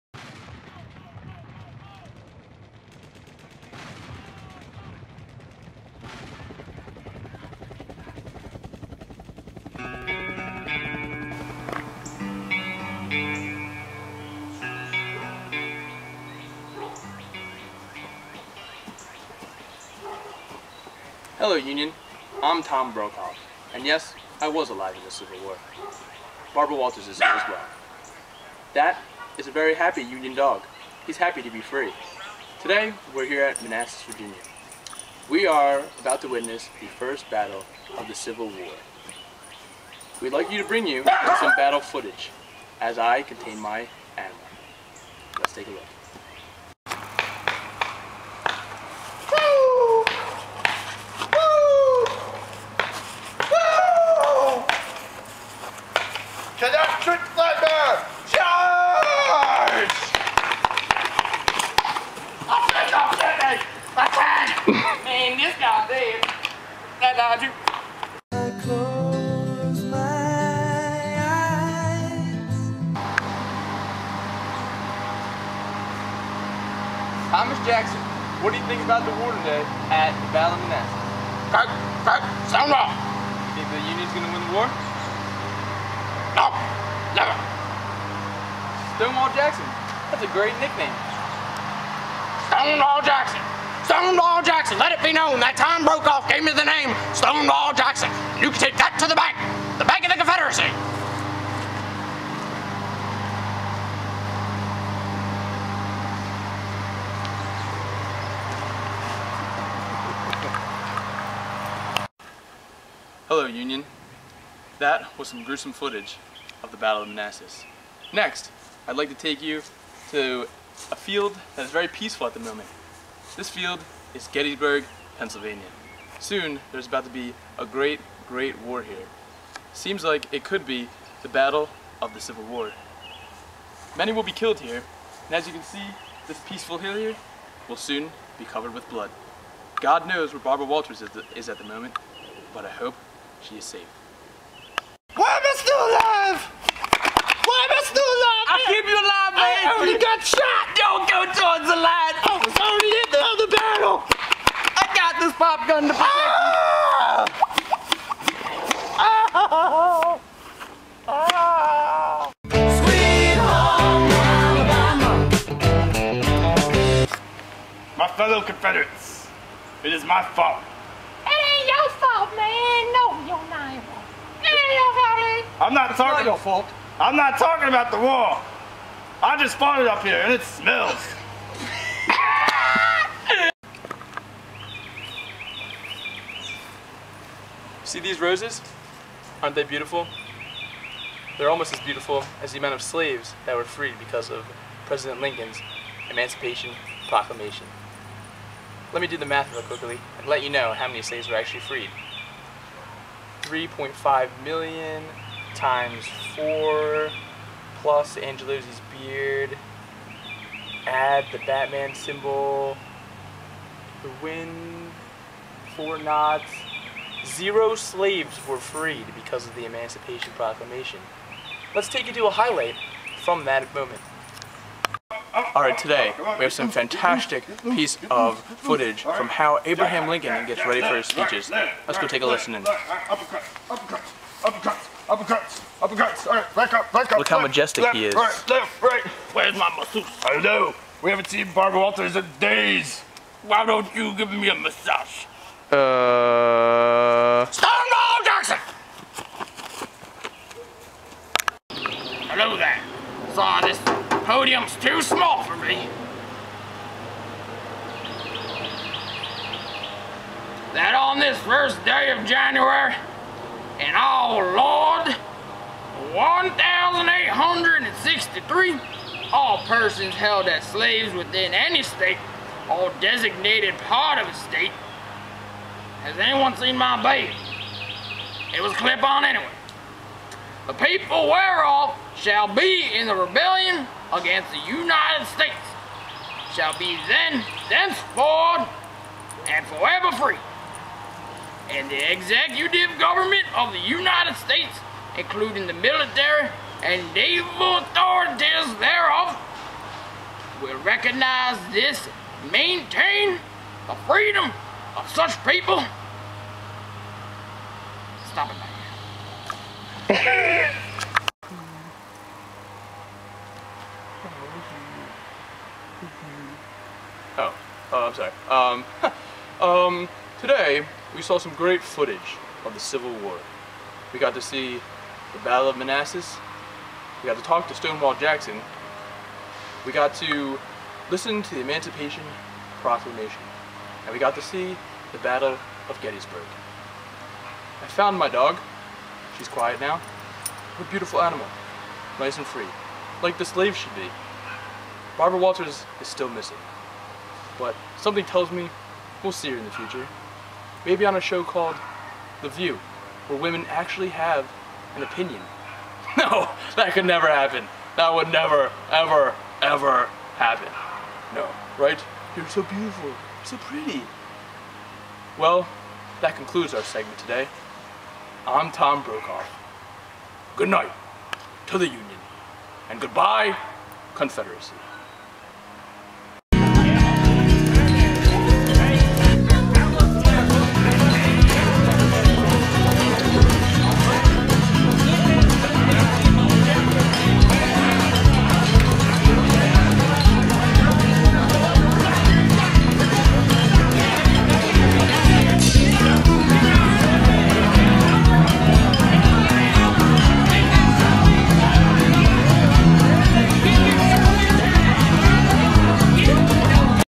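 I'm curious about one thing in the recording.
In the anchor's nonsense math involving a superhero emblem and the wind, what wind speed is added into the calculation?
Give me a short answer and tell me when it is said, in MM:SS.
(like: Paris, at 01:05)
4 knots, at 03:35.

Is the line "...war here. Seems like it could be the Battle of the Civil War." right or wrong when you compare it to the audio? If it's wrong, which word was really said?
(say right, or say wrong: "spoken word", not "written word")
right.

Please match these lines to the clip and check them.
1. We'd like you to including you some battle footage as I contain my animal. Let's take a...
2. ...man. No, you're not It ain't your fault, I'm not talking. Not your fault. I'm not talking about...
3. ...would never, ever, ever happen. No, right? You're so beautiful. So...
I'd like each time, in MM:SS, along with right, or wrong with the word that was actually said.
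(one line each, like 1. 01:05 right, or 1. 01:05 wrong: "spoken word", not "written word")
1. 00:40 wrong: "bring", not "including"
2. 02:52 right
3. 05:58 right.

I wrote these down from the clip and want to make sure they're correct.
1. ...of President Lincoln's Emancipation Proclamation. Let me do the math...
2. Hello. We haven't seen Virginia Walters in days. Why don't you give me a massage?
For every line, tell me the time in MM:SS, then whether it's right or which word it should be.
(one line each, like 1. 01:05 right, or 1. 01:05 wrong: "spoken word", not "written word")
1. 03:14 right
2. 04:00 wrong: "Barbara", not "Virginia".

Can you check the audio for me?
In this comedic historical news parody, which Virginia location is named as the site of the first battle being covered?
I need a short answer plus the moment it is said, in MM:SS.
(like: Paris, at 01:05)
Manassas, Virginia, at 00:33.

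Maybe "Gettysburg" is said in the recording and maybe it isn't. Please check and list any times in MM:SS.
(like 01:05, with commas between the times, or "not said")
02:04, 05:36.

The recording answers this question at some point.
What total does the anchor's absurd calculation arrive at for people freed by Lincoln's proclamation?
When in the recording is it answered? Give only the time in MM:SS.
03:37.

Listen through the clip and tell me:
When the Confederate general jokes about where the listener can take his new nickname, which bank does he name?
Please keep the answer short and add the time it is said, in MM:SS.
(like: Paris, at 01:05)
the Bank of the Confederacy, at 01:39.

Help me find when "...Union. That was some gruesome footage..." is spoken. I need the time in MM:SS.
01:53.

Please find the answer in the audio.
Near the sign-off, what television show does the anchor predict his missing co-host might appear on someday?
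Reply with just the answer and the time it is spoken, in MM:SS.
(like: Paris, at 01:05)
The View, at 05:52.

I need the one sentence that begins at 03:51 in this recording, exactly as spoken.
Let's go take a listen in.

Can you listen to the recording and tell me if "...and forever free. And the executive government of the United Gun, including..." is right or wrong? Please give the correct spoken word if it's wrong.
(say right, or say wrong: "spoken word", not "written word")
wrong: "States", not "Gun".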